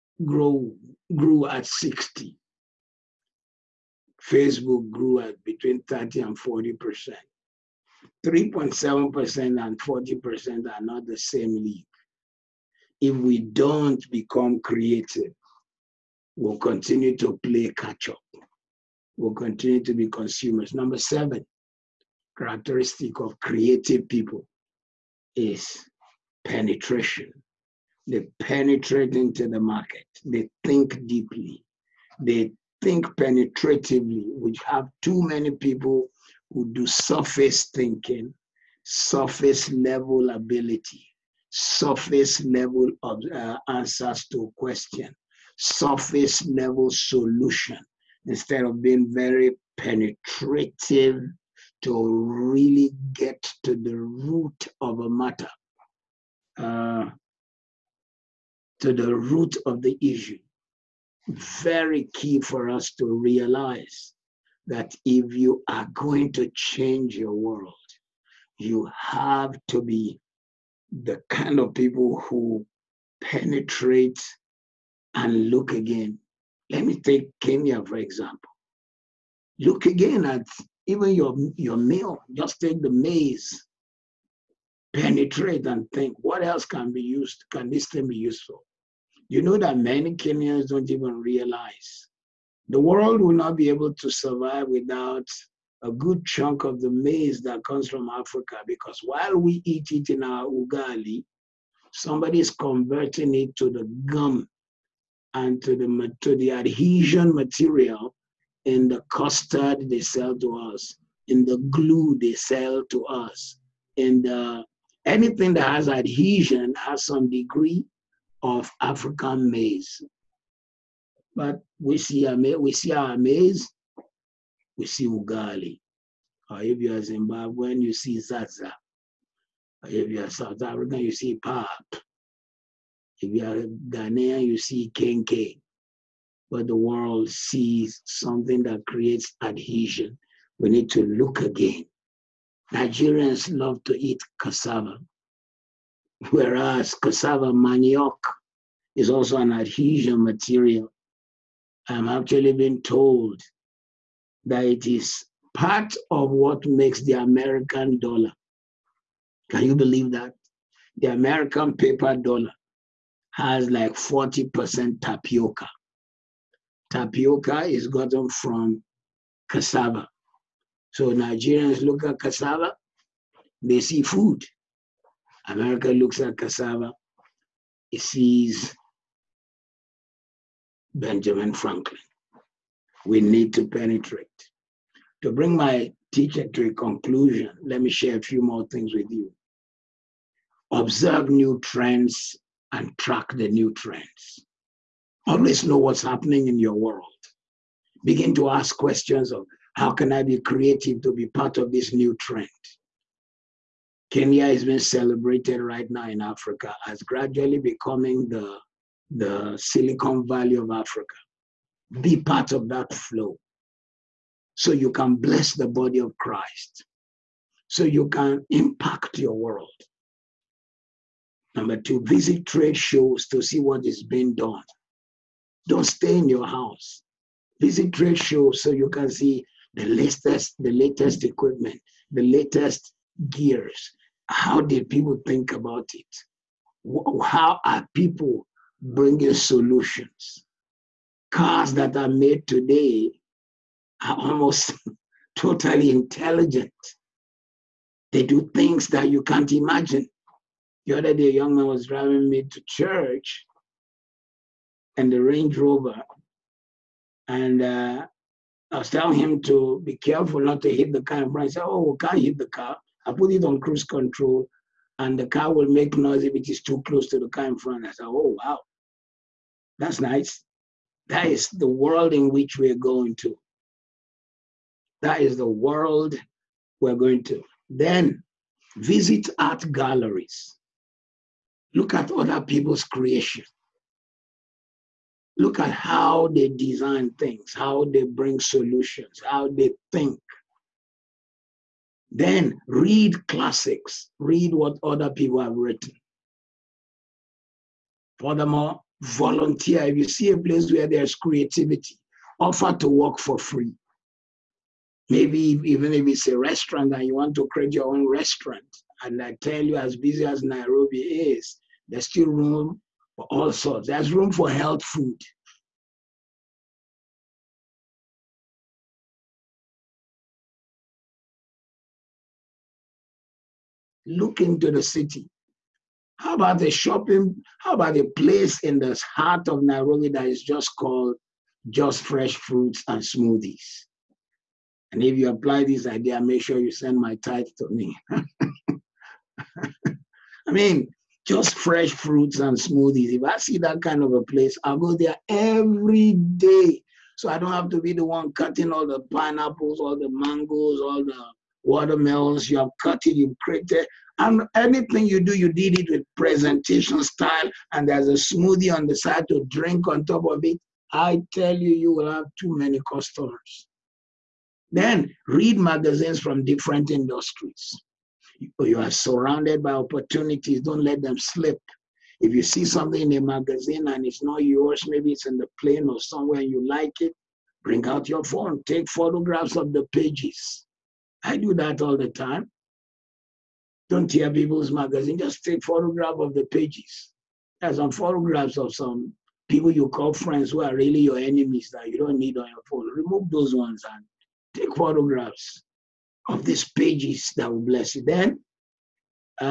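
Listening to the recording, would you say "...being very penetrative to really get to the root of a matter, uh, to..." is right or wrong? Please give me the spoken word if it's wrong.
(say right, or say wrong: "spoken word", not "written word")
right.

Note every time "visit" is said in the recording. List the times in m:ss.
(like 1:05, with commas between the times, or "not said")
3:42, 3:47, 4:38.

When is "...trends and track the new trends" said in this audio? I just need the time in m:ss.
3:11.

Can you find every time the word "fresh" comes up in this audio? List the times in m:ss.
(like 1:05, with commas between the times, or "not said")
5:32, 5:41.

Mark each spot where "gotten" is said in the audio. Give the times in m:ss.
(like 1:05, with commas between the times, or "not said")
2:47.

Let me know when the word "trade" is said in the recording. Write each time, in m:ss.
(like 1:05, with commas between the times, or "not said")
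3:42, 3:47.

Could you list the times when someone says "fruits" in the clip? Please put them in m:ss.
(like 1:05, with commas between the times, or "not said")
5:32, 5:41.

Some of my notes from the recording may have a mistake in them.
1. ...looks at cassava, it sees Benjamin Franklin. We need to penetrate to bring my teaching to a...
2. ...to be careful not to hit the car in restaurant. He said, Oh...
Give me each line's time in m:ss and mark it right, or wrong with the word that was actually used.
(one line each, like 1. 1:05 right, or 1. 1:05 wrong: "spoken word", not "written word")
1. 2:55 right
2. 4:19 wrong: "front", not "restaurant".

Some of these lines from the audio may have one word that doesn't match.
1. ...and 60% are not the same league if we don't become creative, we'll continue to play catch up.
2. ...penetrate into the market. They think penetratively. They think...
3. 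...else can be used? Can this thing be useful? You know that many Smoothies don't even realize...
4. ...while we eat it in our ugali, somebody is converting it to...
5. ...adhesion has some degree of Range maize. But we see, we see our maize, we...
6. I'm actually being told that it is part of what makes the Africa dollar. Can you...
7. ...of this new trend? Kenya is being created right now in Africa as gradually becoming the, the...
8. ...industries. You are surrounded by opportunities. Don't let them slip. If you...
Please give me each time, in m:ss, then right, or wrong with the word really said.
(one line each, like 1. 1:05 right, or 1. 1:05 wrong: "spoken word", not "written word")
1. 0:09 wrong: "40", not "60"
2. 0:28 wrong: "deeply", not "penetratively"
3. 1:26 wrong: "Kenyans", not "Smoothies"
4. 1:39 right
5. 1:55 wrong: "African", not "Range"
6. 2:31 wrong: "American", not "Africa"
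7. 3:21 wrong: "celebrated", not "created"
8. 6:06 right.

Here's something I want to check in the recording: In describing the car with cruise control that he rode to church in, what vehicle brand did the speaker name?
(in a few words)
Range Rover.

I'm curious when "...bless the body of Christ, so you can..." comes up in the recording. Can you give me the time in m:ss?
3:35.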